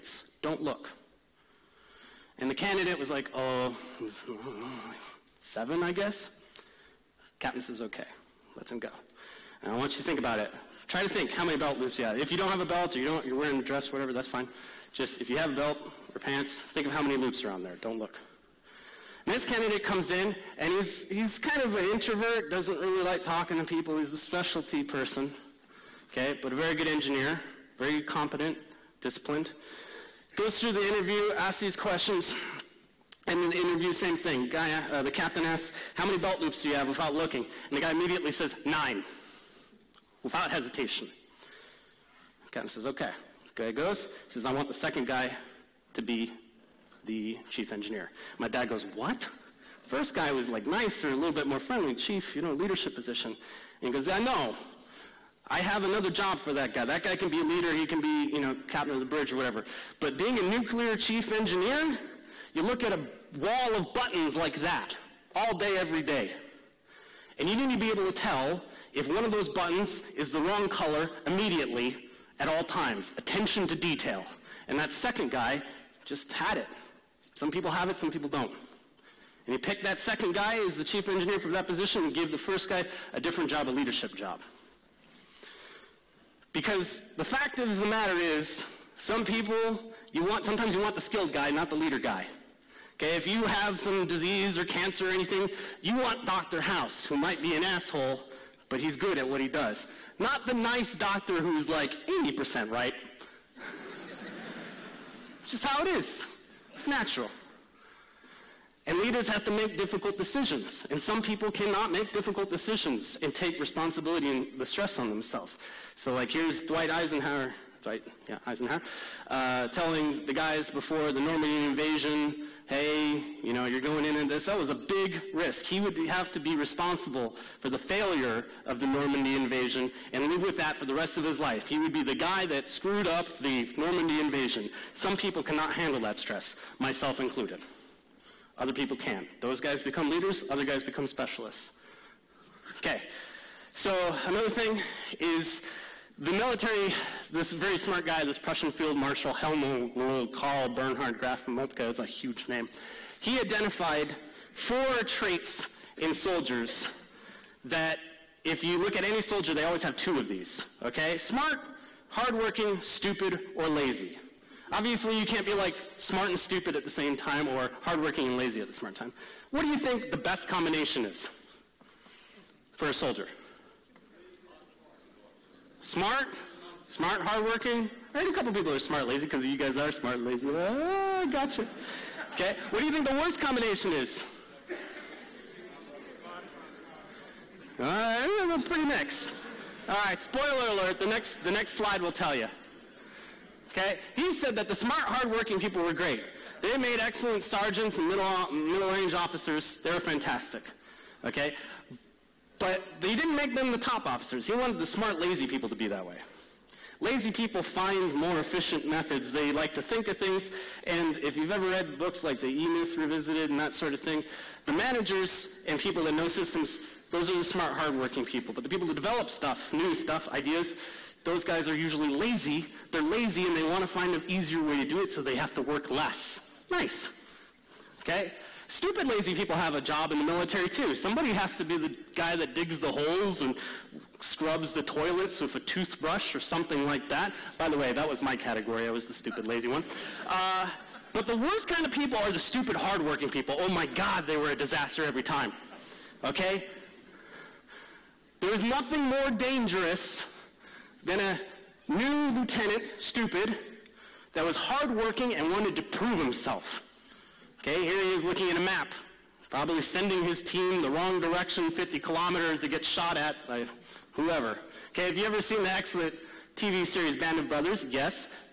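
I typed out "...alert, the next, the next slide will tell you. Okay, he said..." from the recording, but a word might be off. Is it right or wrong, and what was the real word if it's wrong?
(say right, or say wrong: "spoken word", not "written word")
right.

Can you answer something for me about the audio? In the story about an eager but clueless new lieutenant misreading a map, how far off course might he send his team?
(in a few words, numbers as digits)
50 kilometers.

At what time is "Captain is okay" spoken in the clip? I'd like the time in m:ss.
0:07.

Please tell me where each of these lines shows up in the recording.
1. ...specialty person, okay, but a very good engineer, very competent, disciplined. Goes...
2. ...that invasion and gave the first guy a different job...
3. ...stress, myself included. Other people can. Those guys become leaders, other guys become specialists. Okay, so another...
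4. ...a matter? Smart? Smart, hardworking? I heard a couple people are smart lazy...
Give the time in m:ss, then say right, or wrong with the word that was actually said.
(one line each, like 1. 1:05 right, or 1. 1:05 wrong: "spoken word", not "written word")
1. 0:24 right
2. 1:21 wrong: "position", not "invasion"
3. 2:16 right
4. 2:52 wrong: "soldier", not "matter".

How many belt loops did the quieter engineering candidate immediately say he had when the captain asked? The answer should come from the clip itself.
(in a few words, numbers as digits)
9.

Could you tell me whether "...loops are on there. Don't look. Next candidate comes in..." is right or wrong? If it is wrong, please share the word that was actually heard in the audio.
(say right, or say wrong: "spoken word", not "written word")
right.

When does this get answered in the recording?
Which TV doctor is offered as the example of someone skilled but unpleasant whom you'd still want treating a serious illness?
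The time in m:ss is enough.
1:36.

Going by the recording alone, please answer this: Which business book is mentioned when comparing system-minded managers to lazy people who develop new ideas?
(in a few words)
The E Myth Revisited.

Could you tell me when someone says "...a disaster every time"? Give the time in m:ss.
4:04.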